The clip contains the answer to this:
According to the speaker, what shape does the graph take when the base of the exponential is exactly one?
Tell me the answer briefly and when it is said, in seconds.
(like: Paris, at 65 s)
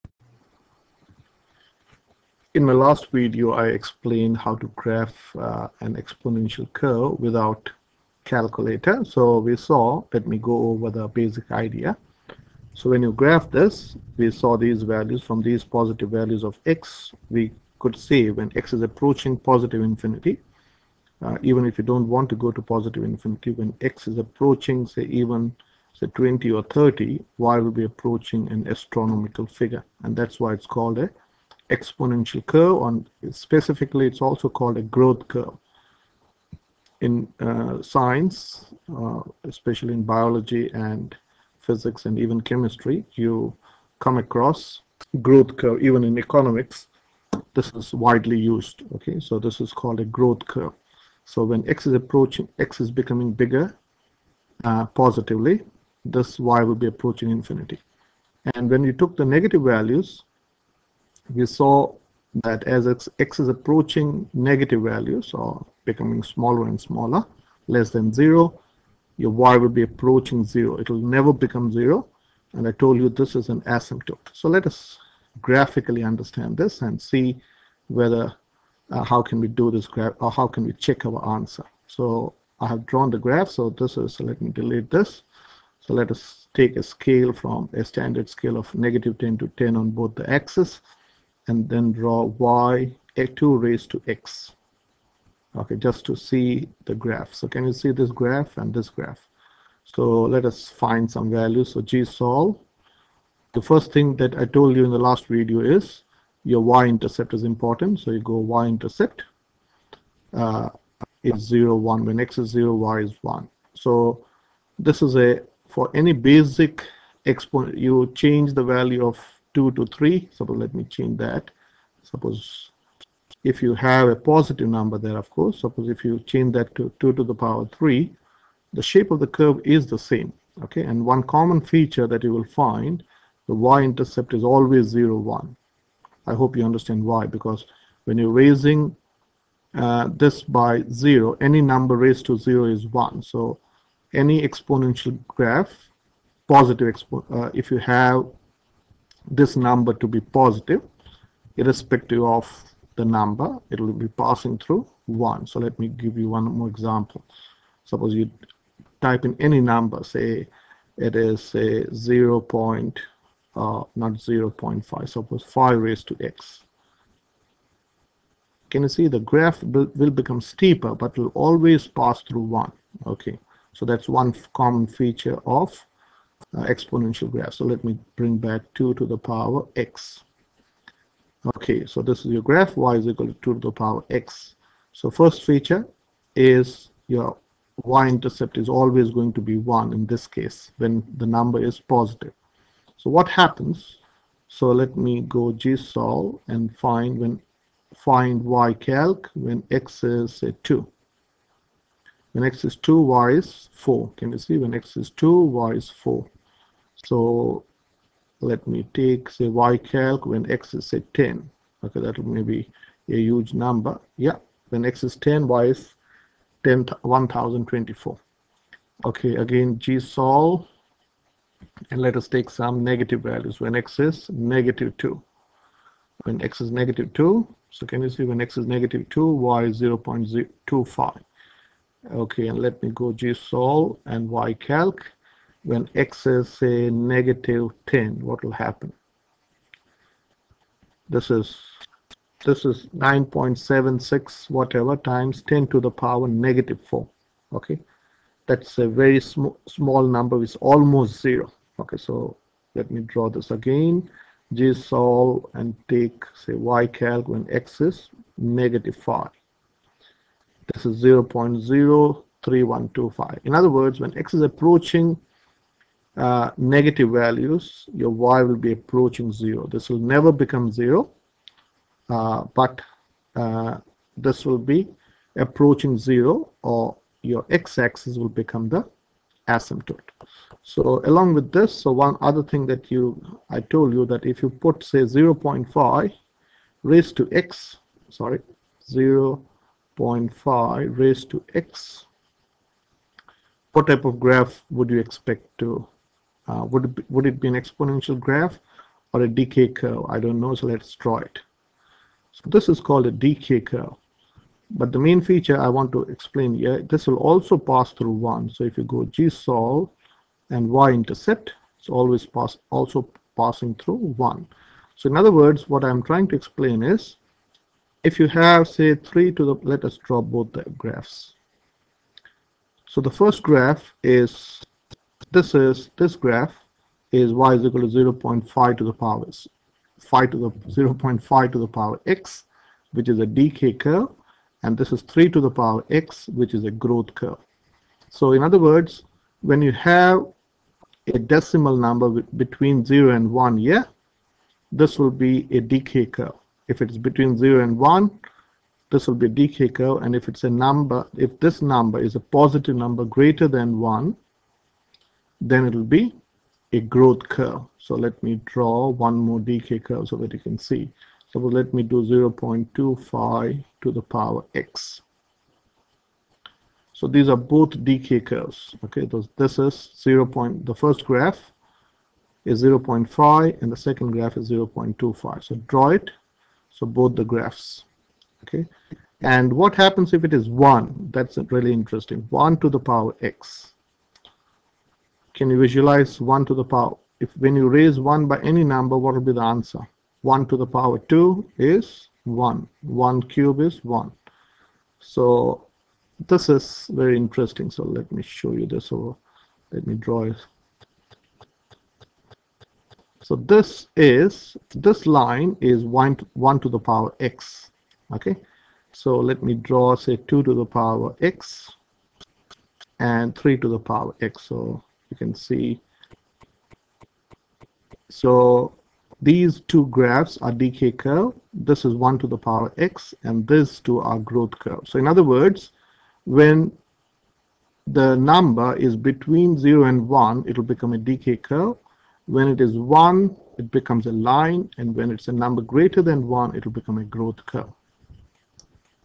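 A line, at 434 s.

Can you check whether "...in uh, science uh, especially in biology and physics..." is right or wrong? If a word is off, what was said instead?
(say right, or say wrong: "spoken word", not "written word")
right.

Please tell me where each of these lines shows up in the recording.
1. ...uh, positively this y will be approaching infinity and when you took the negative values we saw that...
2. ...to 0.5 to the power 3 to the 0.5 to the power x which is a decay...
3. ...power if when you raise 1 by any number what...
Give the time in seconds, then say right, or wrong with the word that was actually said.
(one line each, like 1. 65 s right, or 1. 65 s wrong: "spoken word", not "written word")
1. 54 s right
2. 327 s wrong: "5", not "3"
3. 386 s right.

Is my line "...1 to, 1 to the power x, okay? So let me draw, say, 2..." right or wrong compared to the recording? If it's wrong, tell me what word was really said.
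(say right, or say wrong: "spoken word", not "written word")
right.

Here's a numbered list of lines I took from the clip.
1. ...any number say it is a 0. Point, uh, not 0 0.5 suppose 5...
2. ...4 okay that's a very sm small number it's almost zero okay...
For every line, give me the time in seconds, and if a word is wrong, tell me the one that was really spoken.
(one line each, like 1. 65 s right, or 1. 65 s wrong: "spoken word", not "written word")
1. 159 s right
2. 246 s right.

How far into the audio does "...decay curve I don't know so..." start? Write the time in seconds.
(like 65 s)
299 s.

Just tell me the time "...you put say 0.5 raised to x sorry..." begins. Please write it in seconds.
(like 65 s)
284 s.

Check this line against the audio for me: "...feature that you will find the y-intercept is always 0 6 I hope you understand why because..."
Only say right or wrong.
wrong.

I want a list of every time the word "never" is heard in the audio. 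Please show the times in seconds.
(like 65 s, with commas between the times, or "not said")
71 s, 269 s.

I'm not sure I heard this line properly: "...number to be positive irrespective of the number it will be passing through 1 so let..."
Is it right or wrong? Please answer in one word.
right.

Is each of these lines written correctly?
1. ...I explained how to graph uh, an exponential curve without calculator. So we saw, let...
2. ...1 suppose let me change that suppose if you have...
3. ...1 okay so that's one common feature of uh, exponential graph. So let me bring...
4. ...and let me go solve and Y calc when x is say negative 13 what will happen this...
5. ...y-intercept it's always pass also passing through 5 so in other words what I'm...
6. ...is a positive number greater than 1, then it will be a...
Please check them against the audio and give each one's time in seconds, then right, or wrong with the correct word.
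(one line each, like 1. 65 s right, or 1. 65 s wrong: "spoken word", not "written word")
1. 3 s right
2. 119 s wrong: "3", not "1"
3. 172 s right
4. 232 s wrong: "10", not "13"
5. 310 s wrong: "1", not "5"
6. 351 s right.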